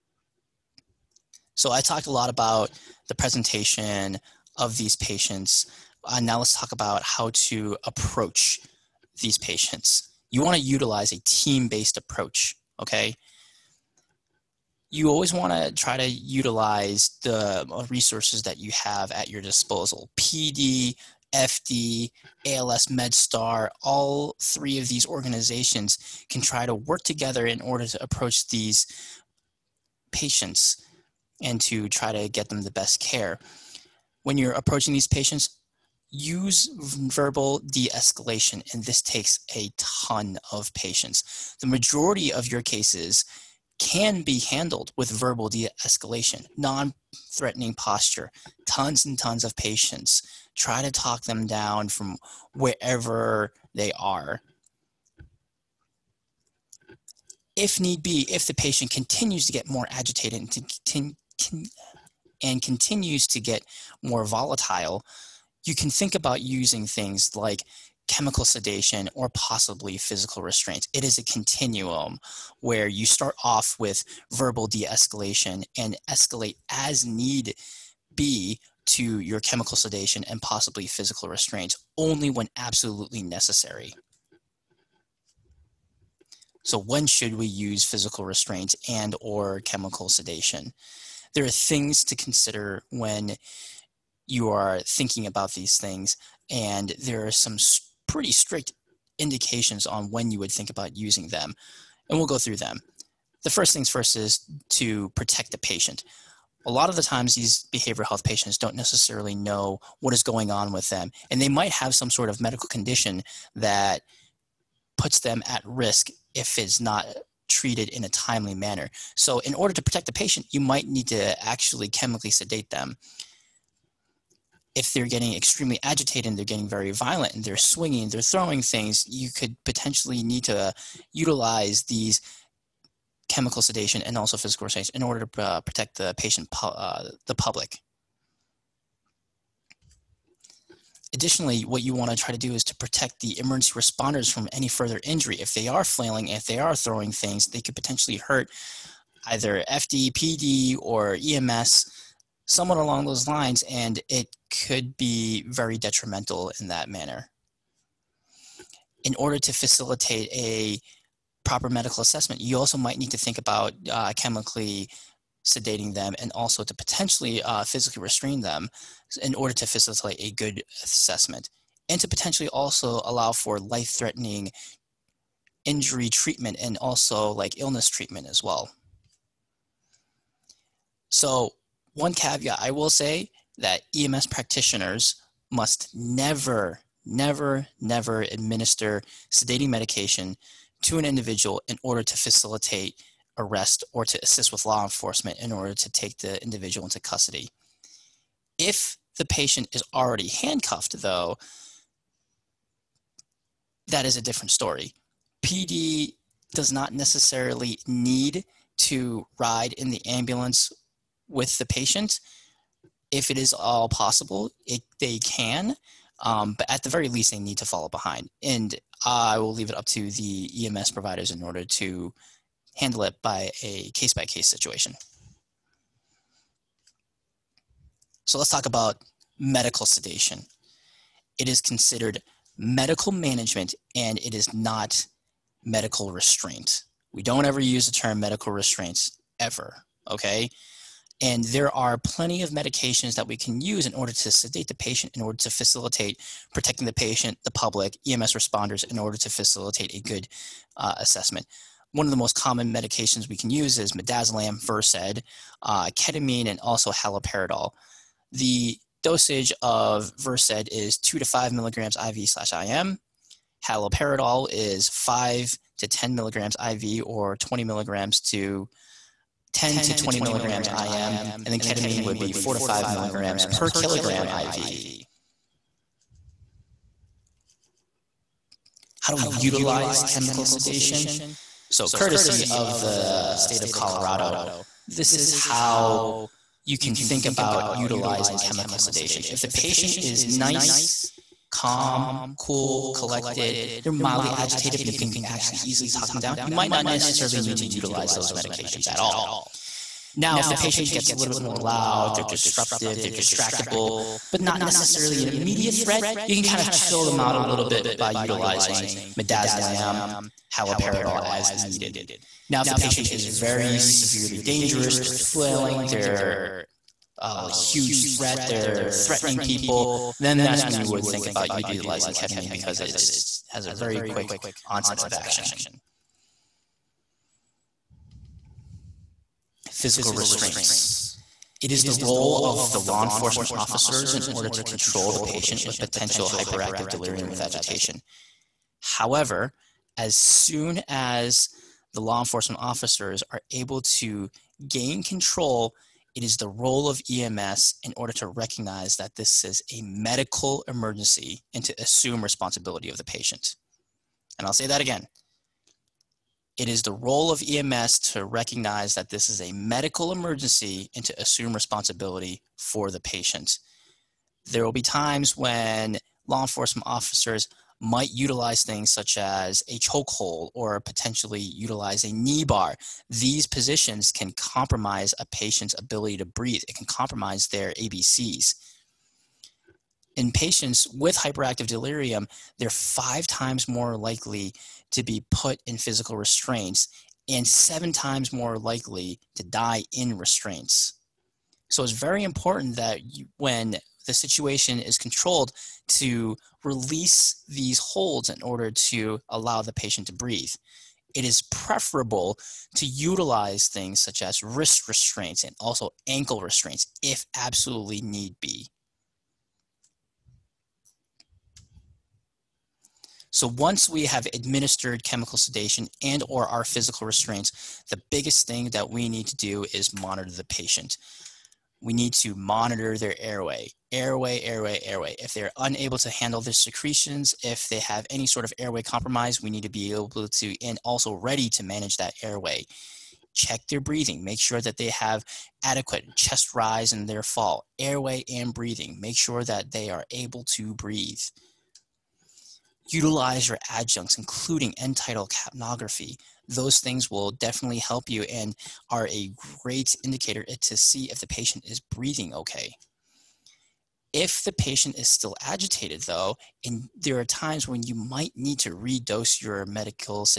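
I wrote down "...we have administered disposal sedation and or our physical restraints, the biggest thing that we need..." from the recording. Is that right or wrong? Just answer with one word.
wrong.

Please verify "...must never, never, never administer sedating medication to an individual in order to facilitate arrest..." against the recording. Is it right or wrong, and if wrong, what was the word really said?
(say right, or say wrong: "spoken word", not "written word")
right.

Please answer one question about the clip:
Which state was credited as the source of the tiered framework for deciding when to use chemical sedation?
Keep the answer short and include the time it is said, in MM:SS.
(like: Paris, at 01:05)
Colorado, at 04:43.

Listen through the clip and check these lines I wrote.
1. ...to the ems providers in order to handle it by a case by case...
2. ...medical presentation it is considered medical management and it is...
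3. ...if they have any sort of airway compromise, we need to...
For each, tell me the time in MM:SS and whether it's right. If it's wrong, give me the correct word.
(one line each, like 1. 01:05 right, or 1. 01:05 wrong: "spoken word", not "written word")
1. 03:39 right
2. 03:49 wrong: "sedation", not "presentation"
3. 07:07 right.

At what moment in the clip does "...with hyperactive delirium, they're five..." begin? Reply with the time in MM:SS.
06:20.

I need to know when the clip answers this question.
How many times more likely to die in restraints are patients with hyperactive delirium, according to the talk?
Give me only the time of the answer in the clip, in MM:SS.
06:27.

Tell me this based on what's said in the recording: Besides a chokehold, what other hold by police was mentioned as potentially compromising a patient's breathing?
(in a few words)
Knee bar.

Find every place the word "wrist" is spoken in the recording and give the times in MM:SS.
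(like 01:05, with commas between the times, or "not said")
06:44.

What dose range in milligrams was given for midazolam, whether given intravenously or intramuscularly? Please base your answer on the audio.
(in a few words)
2 to 5 milligrams.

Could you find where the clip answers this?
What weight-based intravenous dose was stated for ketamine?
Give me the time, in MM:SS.
04:32.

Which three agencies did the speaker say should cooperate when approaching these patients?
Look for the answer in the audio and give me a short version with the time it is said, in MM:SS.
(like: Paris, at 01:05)
PD, FD, ALS MedStar, at 00:20.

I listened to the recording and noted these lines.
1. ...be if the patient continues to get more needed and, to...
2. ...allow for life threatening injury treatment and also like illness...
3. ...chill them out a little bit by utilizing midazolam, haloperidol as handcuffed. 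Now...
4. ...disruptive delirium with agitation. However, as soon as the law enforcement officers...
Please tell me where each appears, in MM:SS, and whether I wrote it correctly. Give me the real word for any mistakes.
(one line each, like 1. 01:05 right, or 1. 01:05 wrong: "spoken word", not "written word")
1. 00:58 wrong: "agitated", not "needed"
2. 02:53 right
3. 05:06 wrong: "needed", not "handcuffed"
4. 05:36 wrong: "hyperactive", not "disruptive".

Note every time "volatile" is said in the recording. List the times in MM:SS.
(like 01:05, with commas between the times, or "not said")
01:04.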